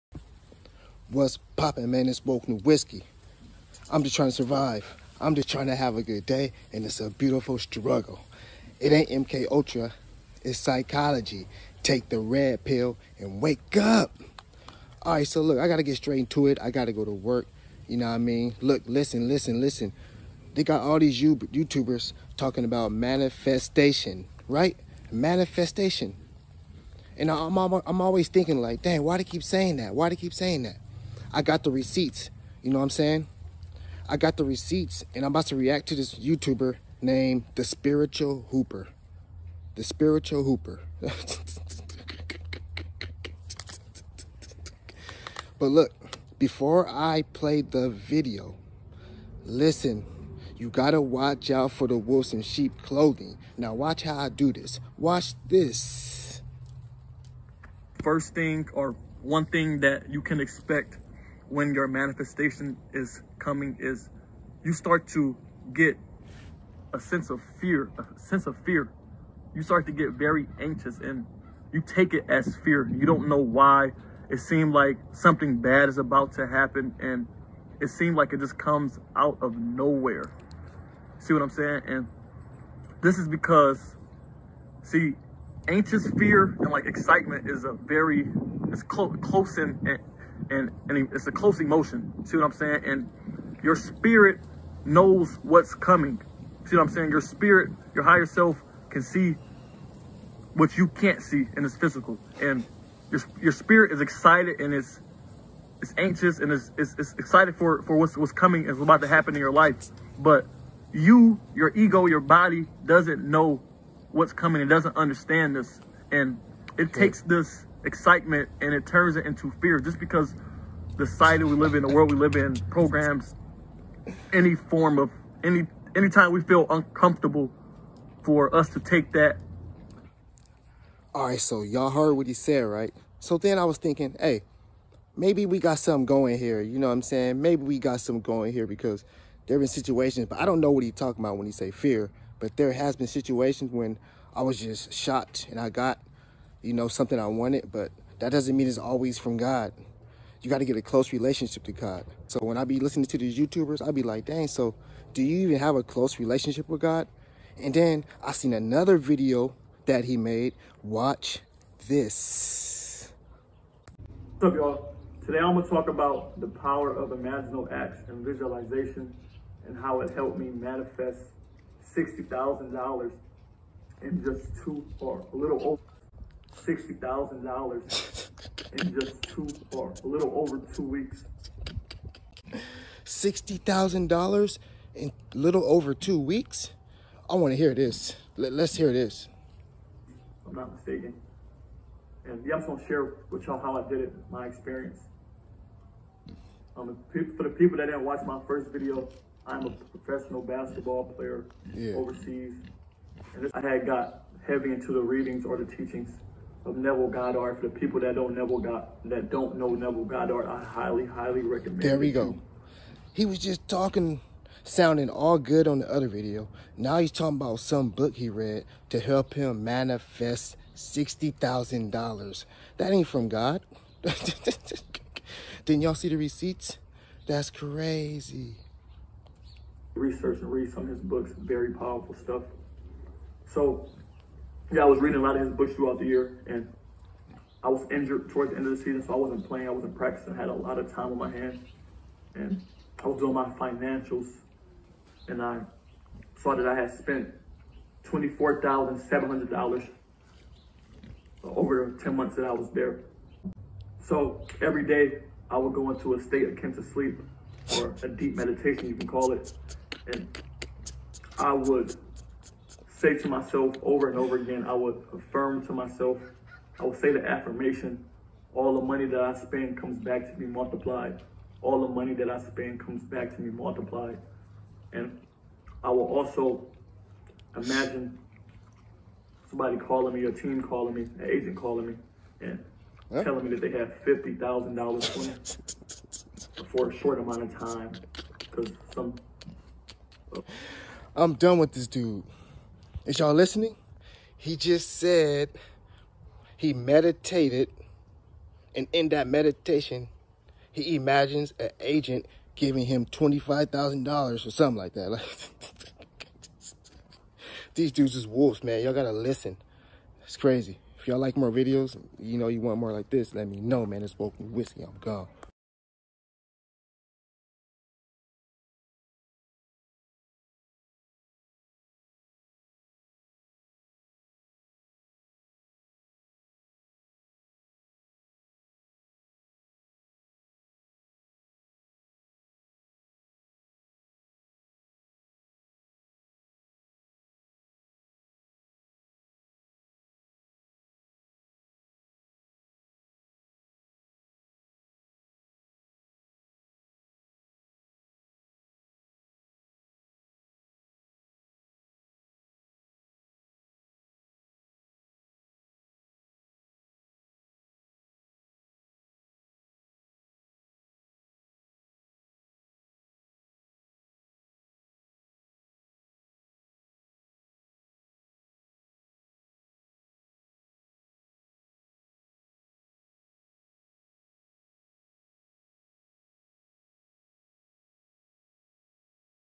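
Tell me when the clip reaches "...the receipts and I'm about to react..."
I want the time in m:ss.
0:34.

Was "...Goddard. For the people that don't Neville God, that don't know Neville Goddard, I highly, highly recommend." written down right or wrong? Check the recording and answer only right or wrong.
right.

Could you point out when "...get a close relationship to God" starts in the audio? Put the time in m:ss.
2:30.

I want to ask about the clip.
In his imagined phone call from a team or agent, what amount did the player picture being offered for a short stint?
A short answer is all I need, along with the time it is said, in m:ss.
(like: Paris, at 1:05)
$50,000, at 4:44.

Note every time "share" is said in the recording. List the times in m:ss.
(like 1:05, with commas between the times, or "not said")
3:12.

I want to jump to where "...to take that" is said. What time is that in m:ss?
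2:08.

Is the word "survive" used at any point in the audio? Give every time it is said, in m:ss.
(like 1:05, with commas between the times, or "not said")
0:04.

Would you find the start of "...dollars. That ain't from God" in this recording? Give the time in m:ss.
3:41.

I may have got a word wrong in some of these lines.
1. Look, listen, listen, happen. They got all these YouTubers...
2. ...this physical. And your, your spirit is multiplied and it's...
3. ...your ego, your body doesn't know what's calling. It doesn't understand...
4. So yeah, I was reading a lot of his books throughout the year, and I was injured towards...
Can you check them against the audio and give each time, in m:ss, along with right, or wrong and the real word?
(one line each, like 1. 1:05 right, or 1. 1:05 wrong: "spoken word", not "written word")
1. 0:18 wrong: "listen", not "happen"
2. 1:41 wrong: "excited", not "multiplied"
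3. 1:51 wrong: "coming", not "calling"
4. 3:53 right.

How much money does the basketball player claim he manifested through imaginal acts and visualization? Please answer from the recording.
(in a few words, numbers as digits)
$60,000.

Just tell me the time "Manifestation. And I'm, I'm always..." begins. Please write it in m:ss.
0:25.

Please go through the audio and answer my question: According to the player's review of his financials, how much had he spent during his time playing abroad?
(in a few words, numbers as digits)
$24,700.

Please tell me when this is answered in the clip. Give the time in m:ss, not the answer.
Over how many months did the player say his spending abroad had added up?
4:12.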